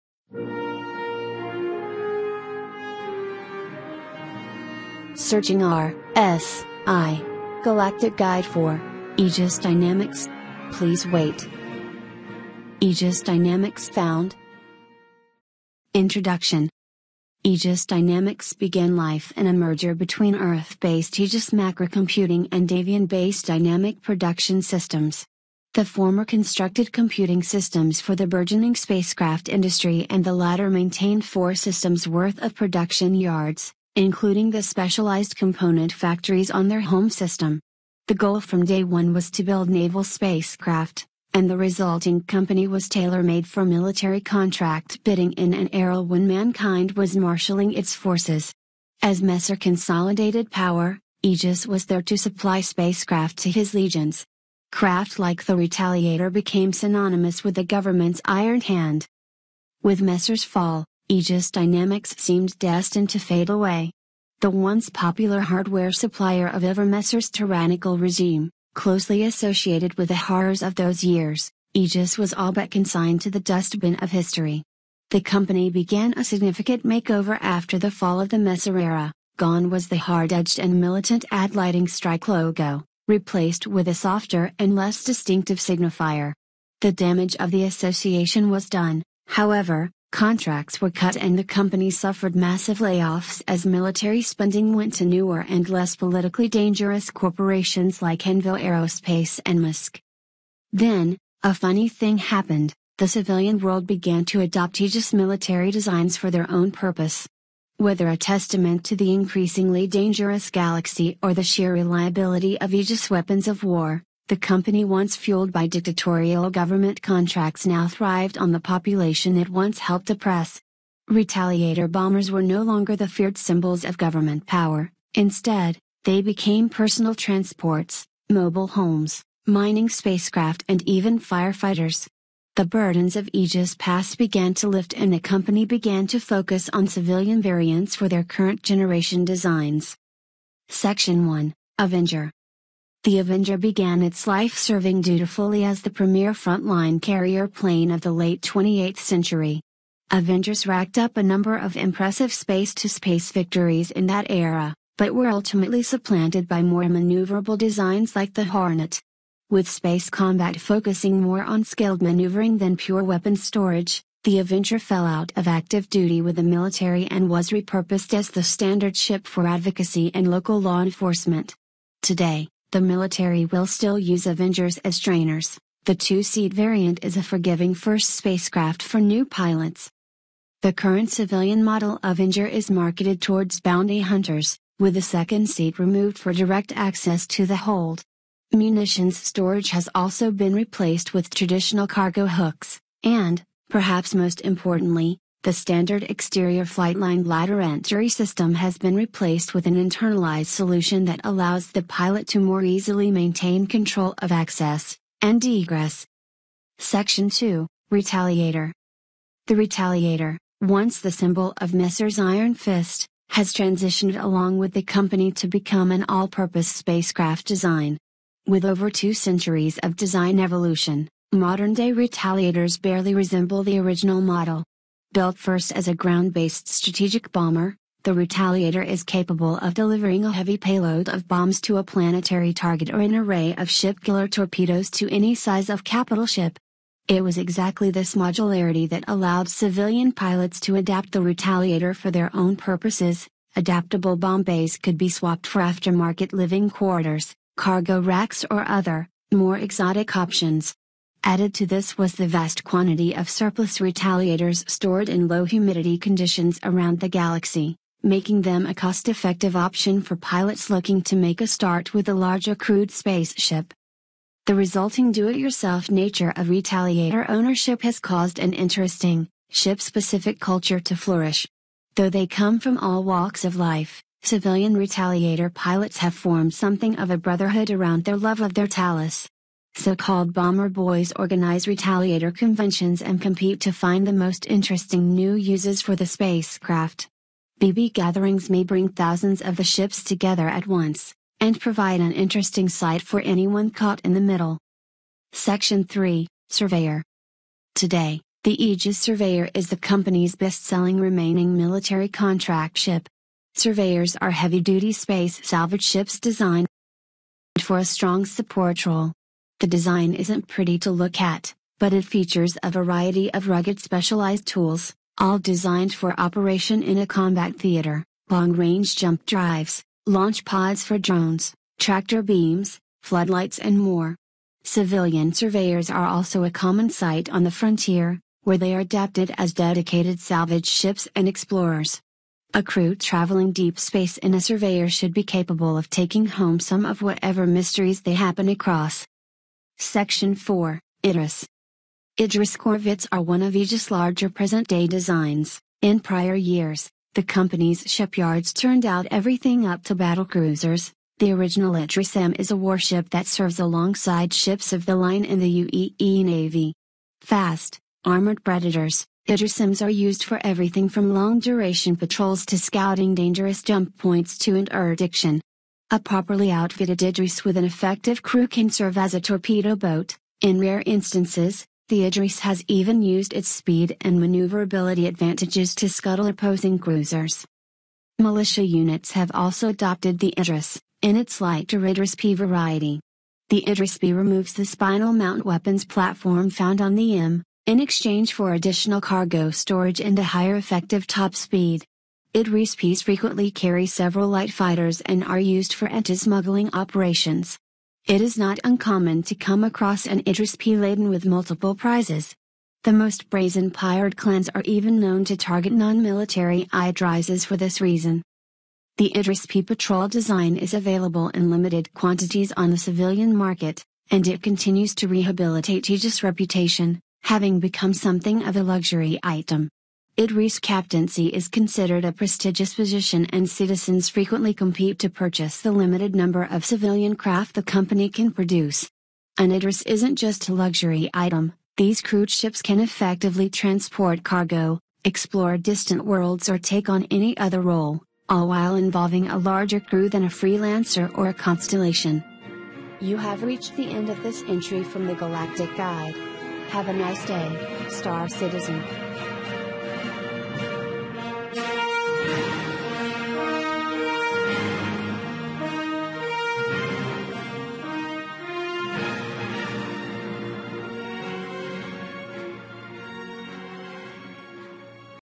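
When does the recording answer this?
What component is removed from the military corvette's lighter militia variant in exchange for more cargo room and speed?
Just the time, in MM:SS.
06:24.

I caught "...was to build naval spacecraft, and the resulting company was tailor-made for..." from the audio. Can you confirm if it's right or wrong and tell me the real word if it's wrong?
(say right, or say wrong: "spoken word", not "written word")
right.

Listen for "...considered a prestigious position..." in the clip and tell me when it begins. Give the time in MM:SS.
07:01.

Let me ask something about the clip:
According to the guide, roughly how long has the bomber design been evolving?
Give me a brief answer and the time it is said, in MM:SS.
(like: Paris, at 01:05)
Over two centuries, at 03:38.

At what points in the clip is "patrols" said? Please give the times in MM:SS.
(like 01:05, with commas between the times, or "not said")
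06:01, 06:49.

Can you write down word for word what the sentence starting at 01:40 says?
Then, a funny thing happened, the civilian world began to adopt Aegis military designs for their own purpose.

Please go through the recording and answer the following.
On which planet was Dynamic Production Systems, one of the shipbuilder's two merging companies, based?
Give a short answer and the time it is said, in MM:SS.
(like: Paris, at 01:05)
Davien, at 00:22.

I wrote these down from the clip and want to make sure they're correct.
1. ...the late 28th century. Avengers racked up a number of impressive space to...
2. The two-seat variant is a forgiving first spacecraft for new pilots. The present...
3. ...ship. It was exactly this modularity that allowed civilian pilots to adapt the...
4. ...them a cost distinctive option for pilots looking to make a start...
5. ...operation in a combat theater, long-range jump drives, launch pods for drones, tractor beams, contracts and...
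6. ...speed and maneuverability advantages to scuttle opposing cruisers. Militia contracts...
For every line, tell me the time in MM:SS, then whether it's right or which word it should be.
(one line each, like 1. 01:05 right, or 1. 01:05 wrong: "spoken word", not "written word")
1. 02:28 right
2. 02:55 wrong: "current", not "present"
3. 03:56 right
4. 04:18 wrong: "effective", not "distinctive"
5. 05:16 wrong: "floodlights", not "contracts"
6. 06:13 wrong: "units", not "contracts".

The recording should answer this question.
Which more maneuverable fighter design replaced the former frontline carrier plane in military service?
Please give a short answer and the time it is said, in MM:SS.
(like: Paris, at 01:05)
Hornet, at 02:38.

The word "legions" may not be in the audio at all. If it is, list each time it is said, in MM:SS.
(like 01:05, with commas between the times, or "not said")
00:53.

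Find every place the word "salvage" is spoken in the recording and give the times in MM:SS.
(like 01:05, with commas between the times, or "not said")
05:05, 05:30.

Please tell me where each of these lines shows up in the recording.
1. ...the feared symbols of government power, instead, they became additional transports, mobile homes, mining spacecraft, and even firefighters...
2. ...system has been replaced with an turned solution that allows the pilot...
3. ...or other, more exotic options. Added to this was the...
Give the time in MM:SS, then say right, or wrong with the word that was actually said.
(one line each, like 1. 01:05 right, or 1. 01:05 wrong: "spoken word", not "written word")
1. 02:02 wrong: "personal", not "additional"
2. 03:18 wrong: "internalized", not "turned"
3. 04:08 right.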